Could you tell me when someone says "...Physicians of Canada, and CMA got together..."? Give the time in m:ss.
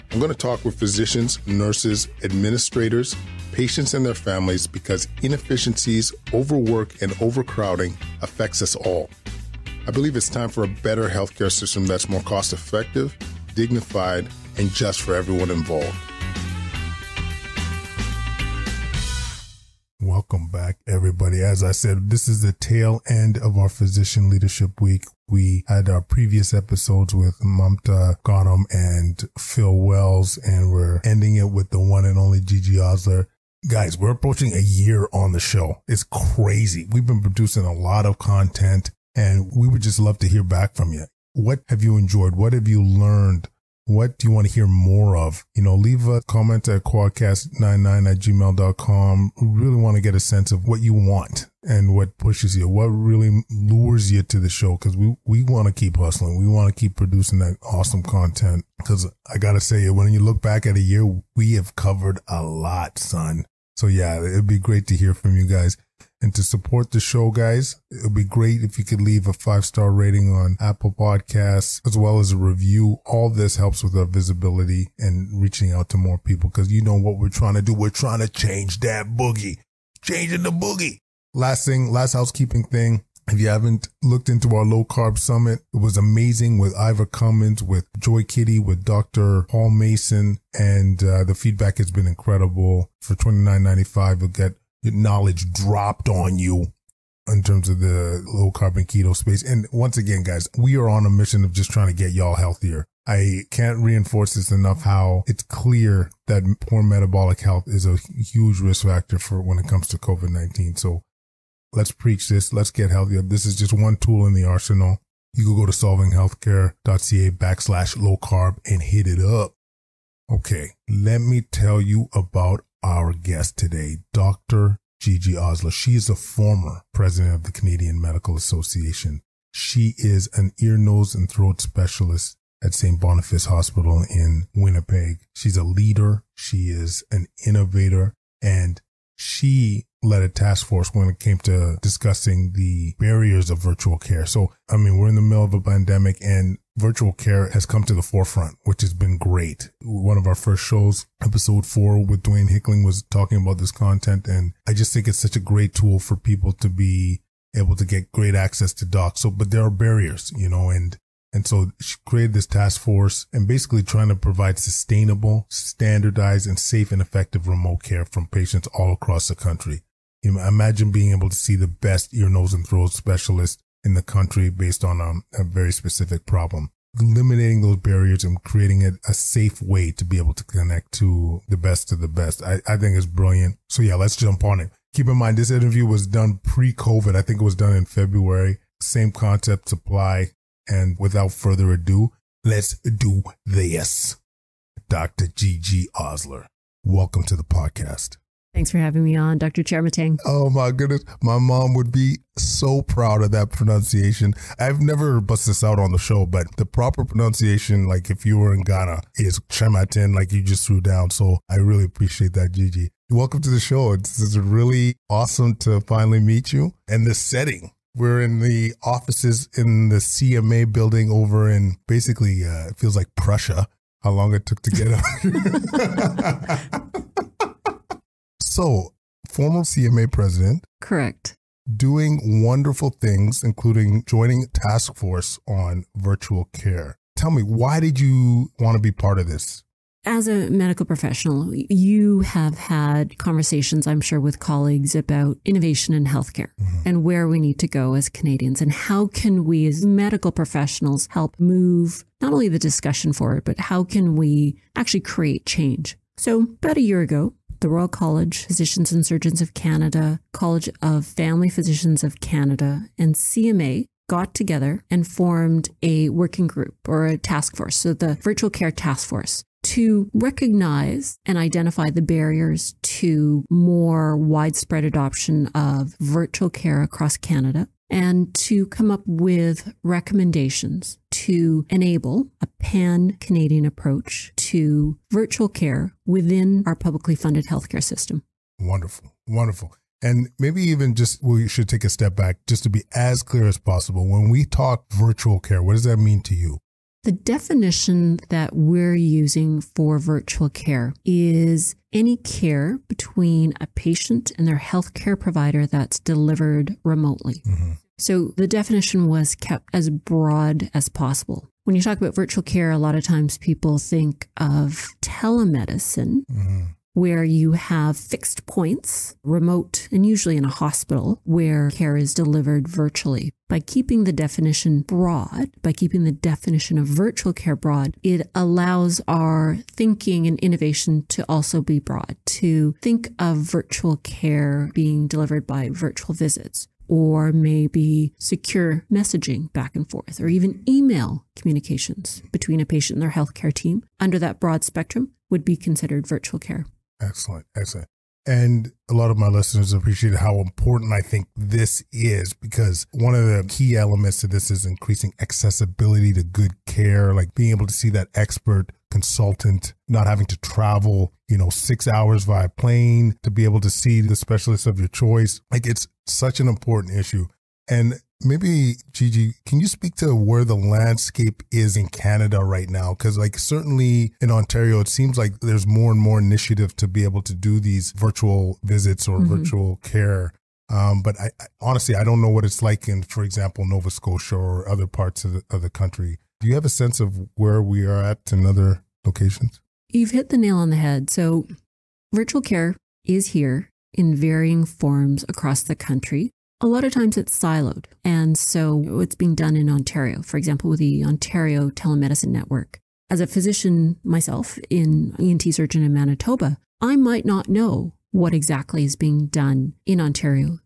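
4:21.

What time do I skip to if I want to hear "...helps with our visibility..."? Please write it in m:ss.
1:13.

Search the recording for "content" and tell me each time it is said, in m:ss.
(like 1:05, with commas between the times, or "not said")
0:38, 0:58, 2:33.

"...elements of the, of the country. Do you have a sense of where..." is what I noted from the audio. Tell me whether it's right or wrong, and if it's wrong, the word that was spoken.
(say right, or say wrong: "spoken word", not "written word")
wrong: "parts", not "elements".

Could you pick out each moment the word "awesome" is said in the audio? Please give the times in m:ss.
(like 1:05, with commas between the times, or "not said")
0:57, 3:35.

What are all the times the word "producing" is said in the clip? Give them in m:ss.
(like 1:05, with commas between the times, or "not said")
0:37, 0:56.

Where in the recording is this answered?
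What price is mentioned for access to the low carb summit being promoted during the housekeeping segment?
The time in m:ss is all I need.
1:33.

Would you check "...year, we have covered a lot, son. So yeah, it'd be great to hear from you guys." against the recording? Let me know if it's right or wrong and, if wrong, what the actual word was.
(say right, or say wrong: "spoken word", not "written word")
right.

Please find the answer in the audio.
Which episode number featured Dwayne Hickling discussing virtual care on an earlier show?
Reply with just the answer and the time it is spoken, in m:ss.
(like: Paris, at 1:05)
4, at 2:31.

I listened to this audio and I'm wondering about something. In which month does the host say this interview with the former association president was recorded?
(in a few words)
February.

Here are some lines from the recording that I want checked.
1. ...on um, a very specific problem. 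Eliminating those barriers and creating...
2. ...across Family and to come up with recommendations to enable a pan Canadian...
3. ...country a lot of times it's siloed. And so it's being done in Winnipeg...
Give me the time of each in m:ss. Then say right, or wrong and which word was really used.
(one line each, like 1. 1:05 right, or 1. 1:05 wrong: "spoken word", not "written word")
1. 2:54 right
2. 4:36 wrong: "Canada", not "Family"
3. 6:35 wrong: "Ontario", not "Winnipeg".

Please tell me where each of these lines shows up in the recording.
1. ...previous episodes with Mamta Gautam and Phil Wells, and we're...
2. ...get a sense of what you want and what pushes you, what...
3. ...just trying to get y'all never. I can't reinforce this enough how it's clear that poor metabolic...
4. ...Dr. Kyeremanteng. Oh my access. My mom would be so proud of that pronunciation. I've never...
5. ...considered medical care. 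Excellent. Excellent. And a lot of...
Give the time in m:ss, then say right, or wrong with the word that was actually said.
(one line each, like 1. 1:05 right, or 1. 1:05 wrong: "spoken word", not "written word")
1. 0:26 right
2. 0:50 right
3. 1:41 wrong: "healthier", not "never"
4. 3:19 wrong: "goodness", not "access"
5. 5:45 wrong: "virtual", not "medical".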